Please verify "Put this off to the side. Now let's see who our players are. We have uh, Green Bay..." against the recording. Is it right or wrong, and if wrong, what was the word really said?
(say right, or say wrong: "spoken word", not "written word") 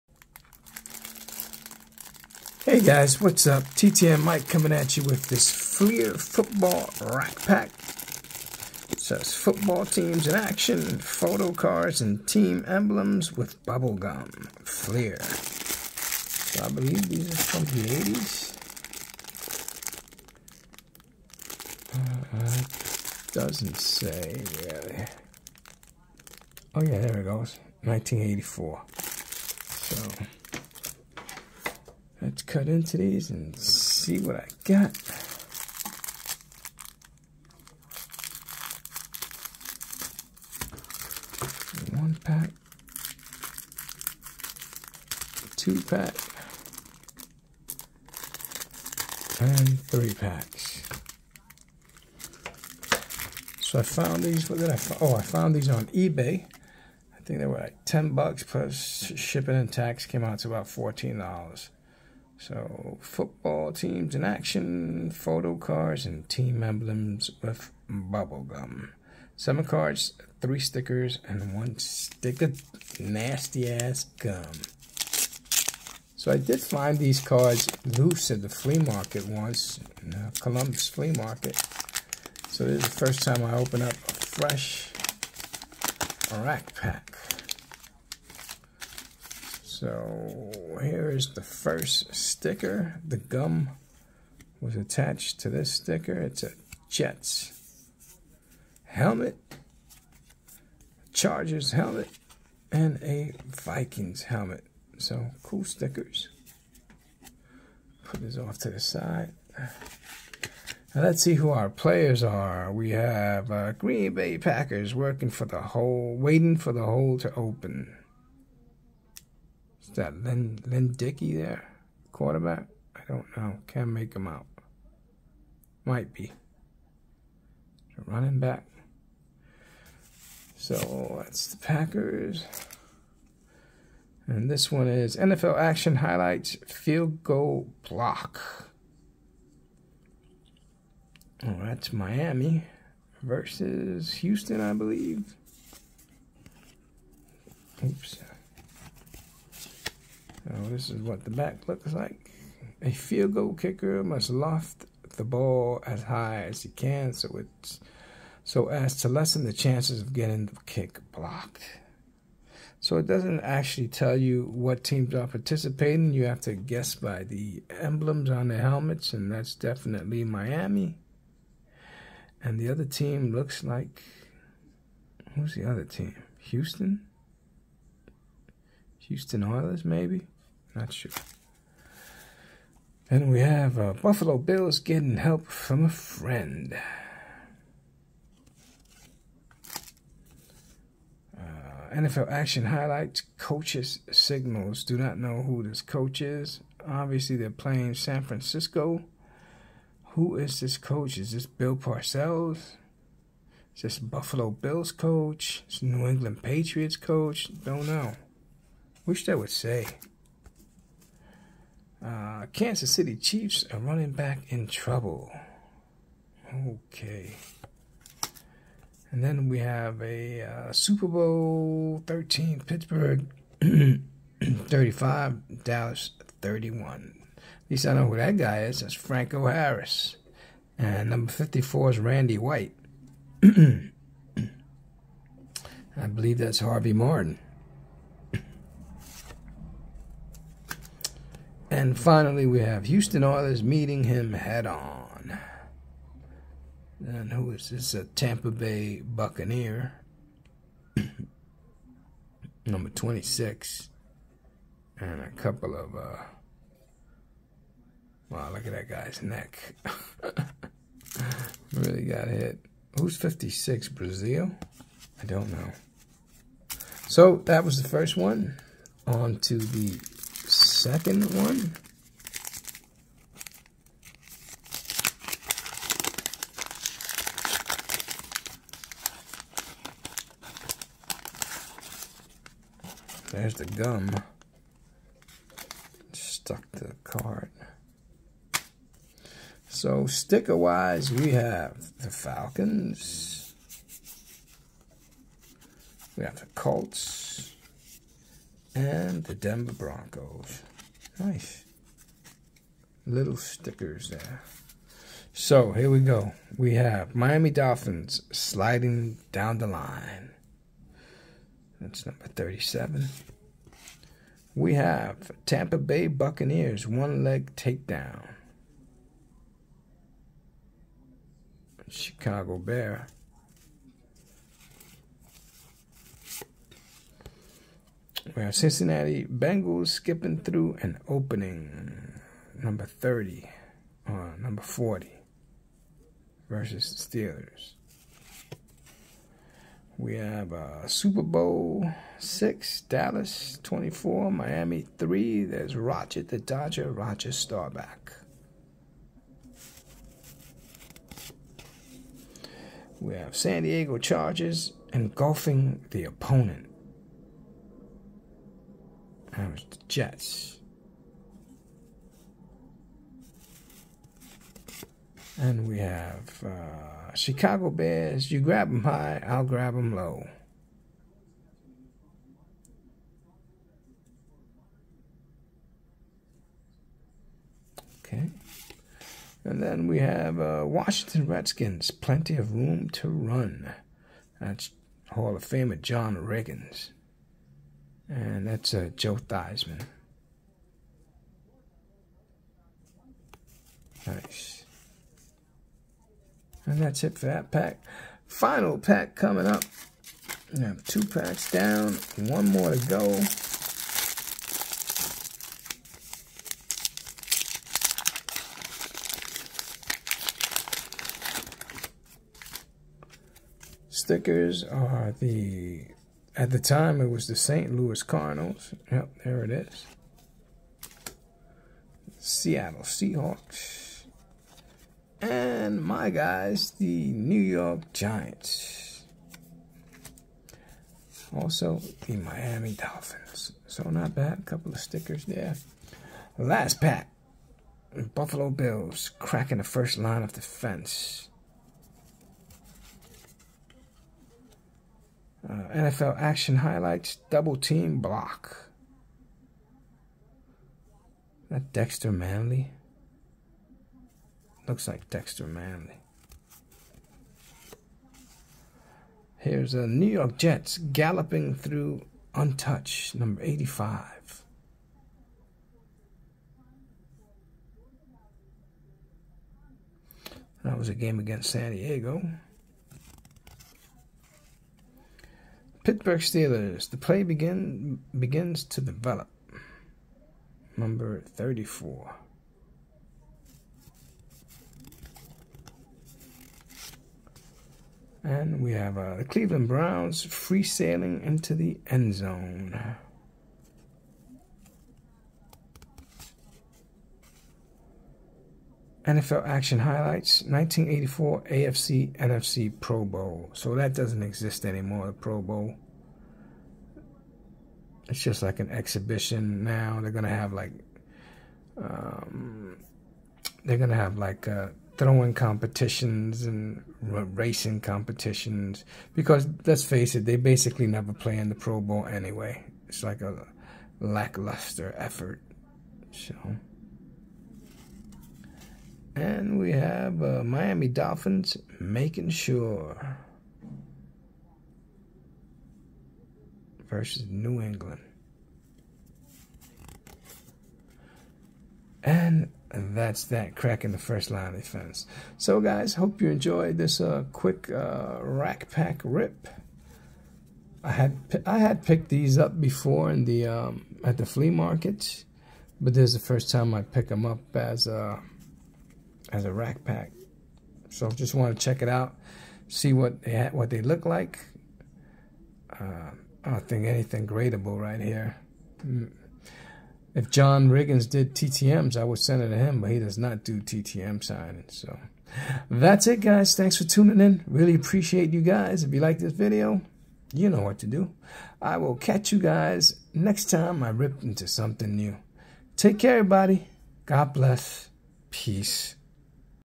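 right.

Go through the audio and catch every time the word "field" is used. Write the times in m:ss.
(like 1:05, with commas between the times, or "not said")
2:16, 2:32.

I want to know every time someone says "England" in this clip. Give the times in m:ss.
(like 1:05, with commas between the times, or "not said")
3:26, 8:57.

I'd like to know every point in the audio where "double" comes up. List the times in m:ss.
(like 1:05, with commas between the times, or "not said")
7:27.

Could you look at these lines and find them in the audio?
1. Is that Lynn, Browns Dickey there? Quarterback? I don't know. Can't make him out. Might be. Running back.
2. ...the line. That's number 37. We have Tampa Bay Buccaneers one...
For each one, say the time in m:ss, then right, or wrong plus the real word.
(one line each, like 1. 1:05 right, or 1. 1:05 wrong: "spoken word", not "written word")
1. 1:59 wrong: "Len", not "Browns"
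2. 5:09 right.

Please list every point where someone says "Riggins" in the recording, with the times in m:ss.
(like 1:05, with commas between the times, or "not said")
6:26, 9:30.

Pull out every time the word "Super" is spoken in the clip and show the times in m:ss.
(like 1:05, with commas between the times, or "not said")
3:40, 5:40.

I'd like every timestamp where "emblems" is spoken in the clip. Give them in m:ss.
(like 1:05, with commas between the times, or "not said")
0:12, 1:06, 2:47.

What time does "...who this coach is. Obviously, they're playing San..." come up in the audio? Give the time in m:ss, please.
3:15.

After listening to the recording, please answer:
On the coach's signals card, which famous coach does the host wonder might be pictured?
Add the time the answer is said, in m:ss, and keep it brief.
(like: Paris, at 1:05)
Bill Parcells, at 3:21.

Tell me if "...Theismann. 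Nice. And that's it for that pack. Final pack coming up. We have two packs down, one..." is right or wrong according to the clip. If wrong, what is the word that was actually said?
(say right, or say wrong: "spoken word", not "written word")
right.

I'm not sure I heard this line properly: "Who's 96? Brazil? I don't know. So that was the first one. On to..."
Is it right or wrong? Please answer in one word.
wrong.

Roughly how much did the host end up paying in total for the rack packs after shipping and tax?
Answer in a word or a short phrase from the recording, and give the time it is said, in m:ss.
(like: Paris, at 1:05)
$14, at 1:00.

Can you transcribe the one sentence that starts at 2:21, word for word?
Oh, that's Miami versus Houston, I believe.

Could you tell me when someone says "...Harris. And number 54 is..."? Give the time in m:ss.
3:49.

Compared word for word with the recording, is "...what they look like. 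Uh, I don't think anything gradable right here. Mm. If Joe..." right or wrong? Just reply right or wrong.
wrong.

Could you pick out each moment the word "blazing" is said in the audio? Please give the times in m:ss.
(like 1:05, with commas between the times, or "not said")
not said.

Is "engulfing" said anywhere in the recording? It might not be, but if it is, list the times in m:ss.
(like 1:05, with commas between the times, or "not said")
5:54.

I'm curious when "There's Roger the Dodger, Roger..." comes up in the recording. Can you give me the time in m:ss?
5:45.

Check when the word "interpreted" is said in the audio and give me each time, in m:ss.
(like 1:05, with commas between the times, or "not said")
not said.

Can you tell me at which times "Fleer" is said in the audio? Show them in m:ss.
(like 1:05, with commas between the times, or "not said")
0:05, 0:14.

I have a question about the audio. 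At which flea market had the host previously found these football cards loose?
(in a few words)
Columbus flea market.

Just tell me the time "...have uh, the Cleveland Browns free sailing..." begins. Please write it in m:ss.
8:08.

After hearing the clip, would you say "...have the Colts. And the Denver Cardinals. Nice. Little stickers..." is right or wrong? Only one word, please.
wrong.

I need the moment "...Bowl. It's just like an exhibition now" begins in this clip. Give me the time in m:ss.
8:25.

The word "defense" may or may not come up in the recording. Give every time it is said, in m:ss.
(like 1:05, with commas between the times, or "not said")
7:20, 9:04.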